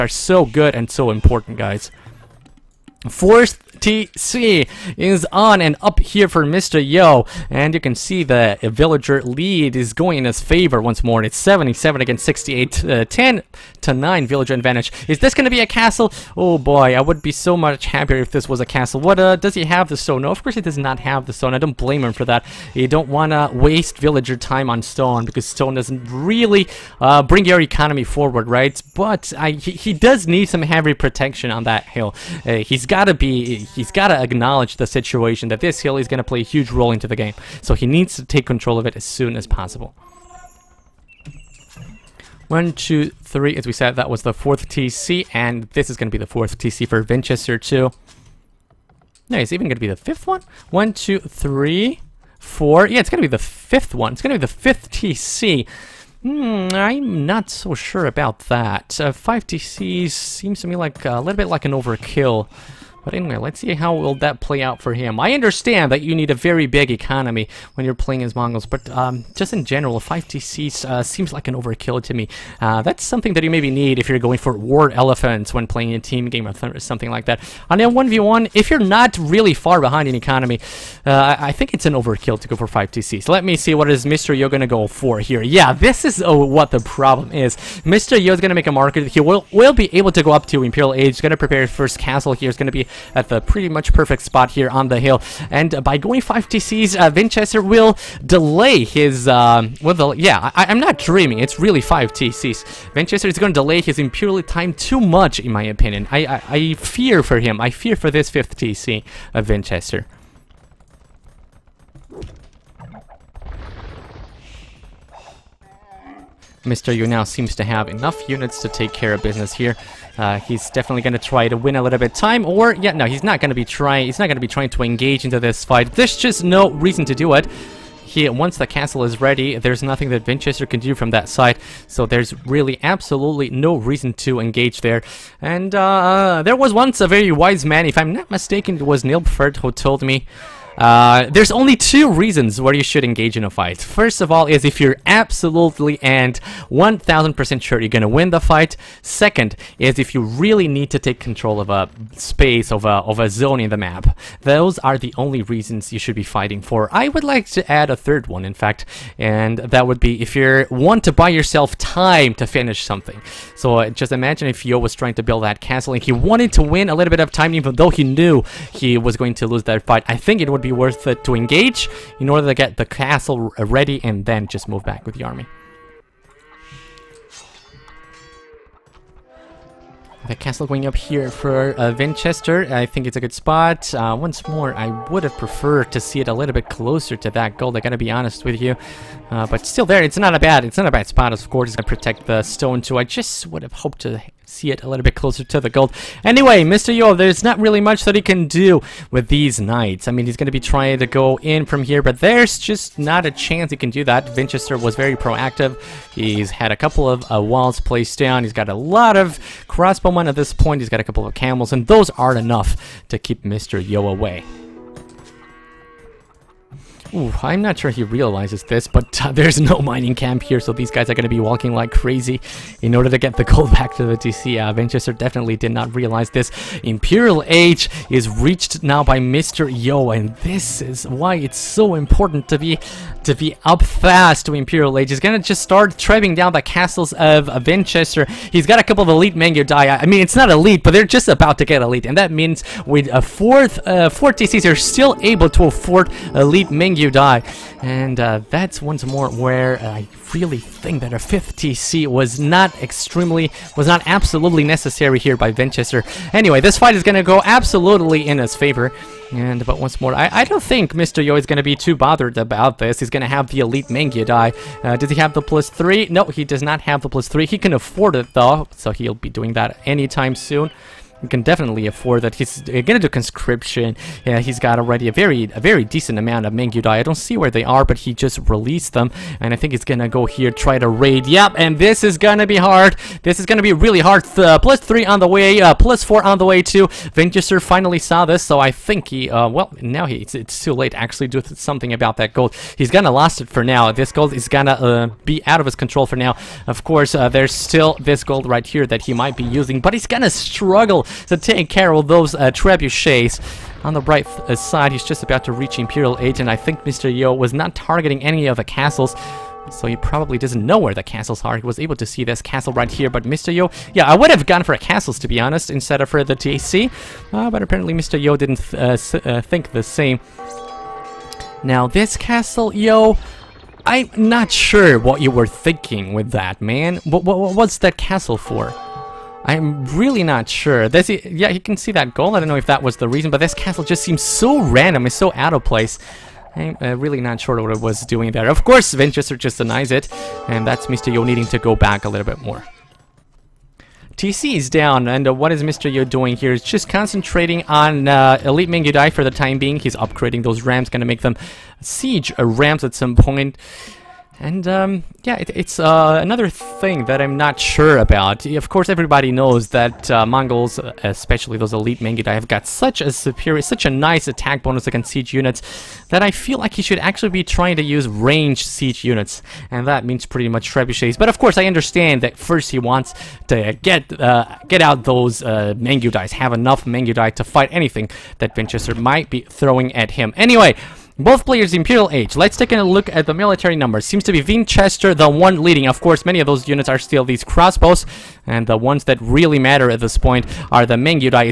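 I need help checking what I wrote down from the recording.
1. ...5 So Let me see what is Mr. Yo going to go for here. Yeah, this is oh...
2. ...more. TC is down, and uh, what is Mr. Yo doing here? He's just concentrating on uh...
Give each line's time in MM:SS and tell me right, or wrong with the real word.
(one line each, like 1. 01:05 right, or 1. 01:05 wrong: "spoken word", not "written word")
1. 01:22 right
2. 05:42 right.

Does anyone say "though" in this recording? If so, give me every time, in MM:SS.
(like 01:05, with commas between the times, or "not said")
02:47, 04:28.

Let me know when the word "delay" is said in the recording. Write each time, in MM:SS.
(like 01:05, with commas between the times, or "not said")
01:38, 01:43.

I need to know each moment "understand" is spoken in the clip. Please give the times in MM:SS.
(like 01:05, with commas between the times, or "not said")
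01:05, 06:11.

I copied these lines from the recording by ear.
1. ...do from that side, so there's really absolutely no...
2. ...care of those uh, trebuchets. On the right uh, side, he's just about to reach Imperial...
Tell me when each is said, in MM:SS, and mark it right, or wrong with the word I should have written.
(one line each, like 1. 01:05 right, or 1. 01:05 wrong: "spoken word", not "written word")
1. 02:10 right
2. 05:01 right.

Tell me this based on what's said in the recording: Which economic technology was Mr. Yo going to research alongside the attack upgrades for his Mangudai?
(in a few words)
conscription.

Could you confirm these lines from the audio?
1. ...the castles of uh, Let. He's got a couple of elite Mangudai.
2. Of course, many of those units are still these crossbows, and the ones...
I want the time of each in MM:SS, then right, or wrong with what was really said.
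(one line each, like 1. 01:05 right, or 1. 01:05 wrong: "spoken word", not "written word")
1. 03:56 wrong: "Vinchester", not "Let"
2. 06:25 right.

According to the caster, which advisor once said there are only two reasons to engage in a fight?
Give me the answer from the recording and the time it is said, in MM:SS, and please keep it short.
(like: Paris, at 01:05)
Nilbert, at 02:19.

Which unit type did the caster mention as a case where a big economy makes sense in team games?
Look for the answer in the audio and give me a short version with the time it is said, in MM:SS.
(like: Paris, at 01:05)
war elephants, at 01:14.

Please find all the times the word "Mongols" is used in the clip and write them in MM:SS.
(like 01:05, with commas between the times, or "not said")
01:08, 06:00.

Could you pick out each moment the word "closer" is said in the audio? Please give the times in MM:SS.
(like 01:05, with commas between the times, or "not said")
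03:06, 03:15.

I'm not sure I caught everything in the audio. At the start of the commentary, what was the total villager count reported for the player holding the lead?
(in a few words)
77.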